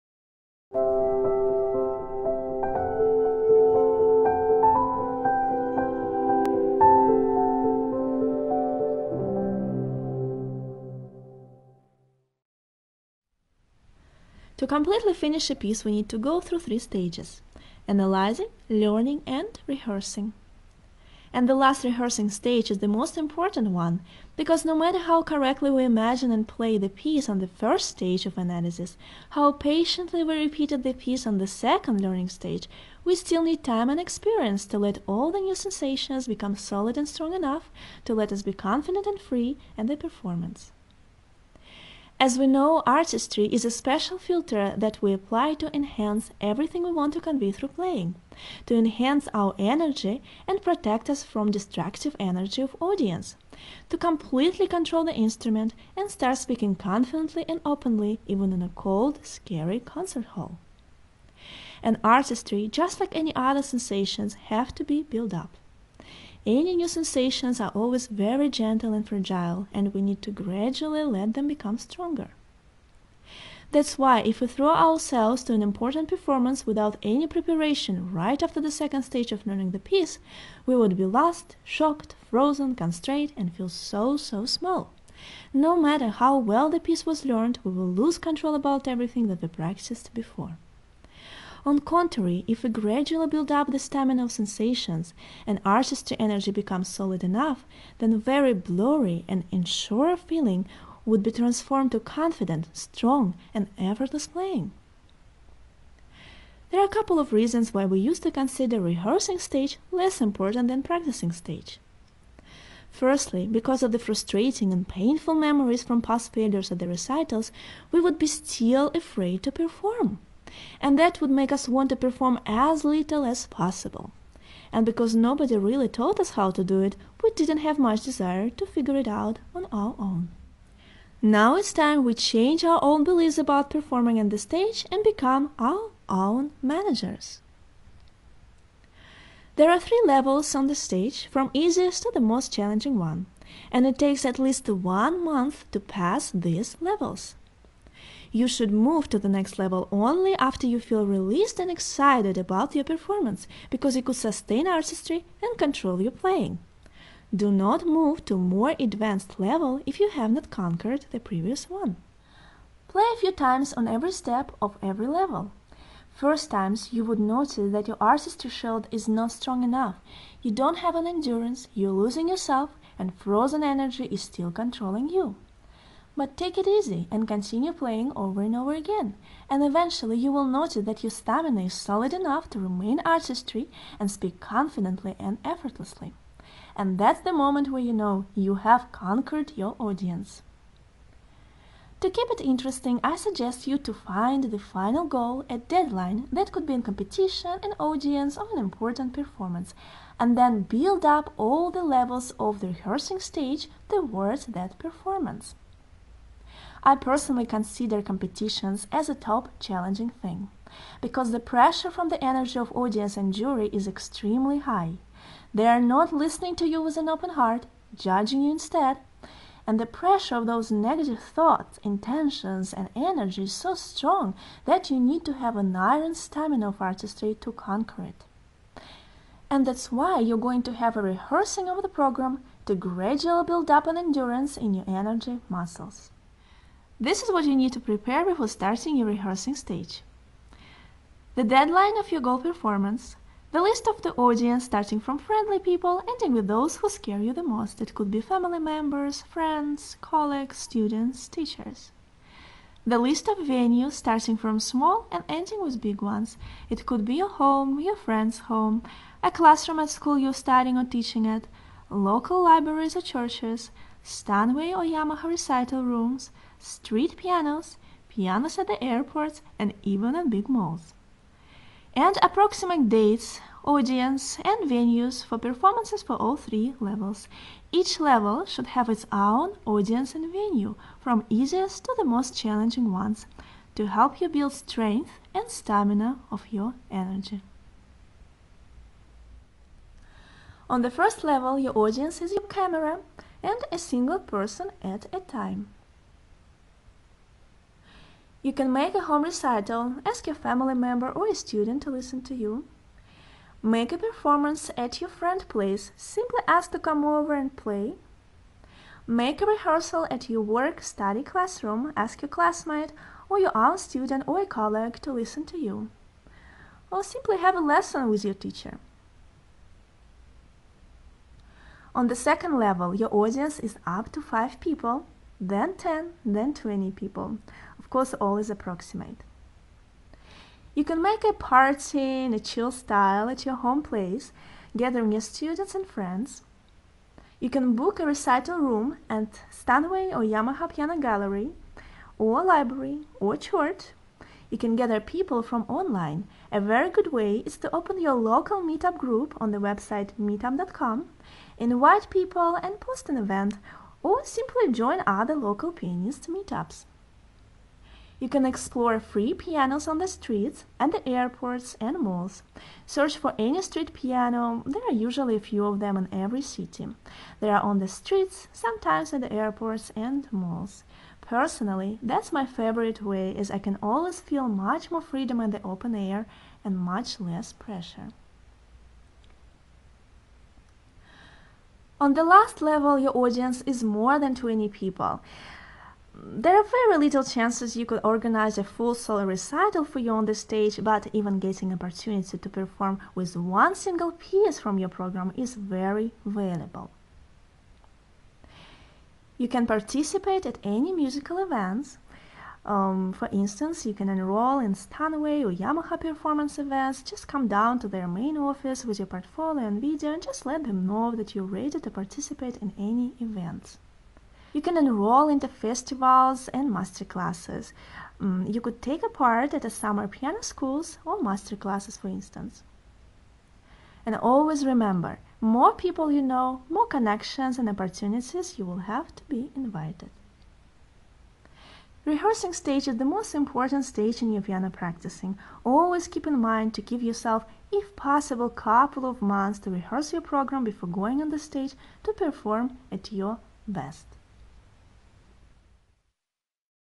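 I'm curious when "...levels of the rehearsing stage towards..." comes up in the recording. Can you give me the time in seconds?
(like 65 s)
201 s.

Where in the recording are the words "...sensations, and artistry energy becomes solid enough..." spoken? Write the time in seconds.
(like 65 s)
94 s.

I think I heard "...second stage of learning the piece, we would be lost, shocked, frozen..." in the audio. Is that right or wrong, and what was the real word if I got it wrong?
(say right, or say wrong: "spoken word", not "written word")
right.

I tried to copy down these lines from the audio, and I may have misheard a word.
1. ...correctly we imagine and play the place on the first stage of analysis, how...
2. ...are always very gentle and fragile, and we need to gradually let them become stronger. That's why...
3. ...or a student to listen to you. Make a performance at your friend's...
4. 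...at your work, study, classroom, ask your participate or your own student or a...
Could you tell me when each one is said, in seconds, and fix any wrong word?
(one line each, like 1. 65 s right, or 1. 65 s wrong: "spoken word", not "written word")
1. 25 s wrong: "piece", not "place"
2. 67 s right
3. 301 s right
4. 310 s wrong: "classmate", not "participate".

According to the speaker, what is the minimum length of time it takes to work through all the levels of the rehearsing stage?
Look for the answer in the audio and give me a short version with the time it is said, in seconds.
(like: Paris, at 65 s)
one month, at 144 s.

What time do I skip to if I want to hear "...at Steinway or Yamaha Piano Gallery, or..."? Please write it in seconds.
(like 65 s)
339 s.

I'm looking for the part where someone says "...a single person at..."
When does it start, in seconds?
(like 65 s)
293 s.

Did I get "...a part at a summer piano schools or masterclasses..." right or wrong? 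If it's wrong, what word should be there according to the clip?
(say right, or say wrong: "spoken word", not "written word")
right.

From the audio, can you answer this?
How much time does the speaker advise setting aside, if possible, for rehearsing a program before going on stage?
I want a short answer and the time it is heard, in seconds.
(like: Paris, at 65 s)
couple of months, at 438 s.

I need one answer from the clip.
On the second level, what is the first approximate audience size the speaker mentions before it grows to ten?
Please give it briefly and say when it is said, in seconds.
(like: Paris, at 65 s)
5 people, at 324 s.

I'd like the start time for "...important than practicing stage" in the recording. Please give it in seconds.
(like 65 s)
110 s.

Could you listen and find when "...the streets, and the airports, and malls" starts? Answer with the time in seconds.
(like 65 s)
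359 s.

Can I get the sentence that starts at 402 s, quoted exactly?
Um, for instance, you can enroll in Steinway or Yamaha performance events.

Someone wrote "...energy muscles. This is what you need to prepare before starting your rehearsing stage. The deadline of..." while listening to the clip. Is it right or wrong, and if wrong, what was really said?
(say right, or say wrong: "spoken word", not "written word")
right.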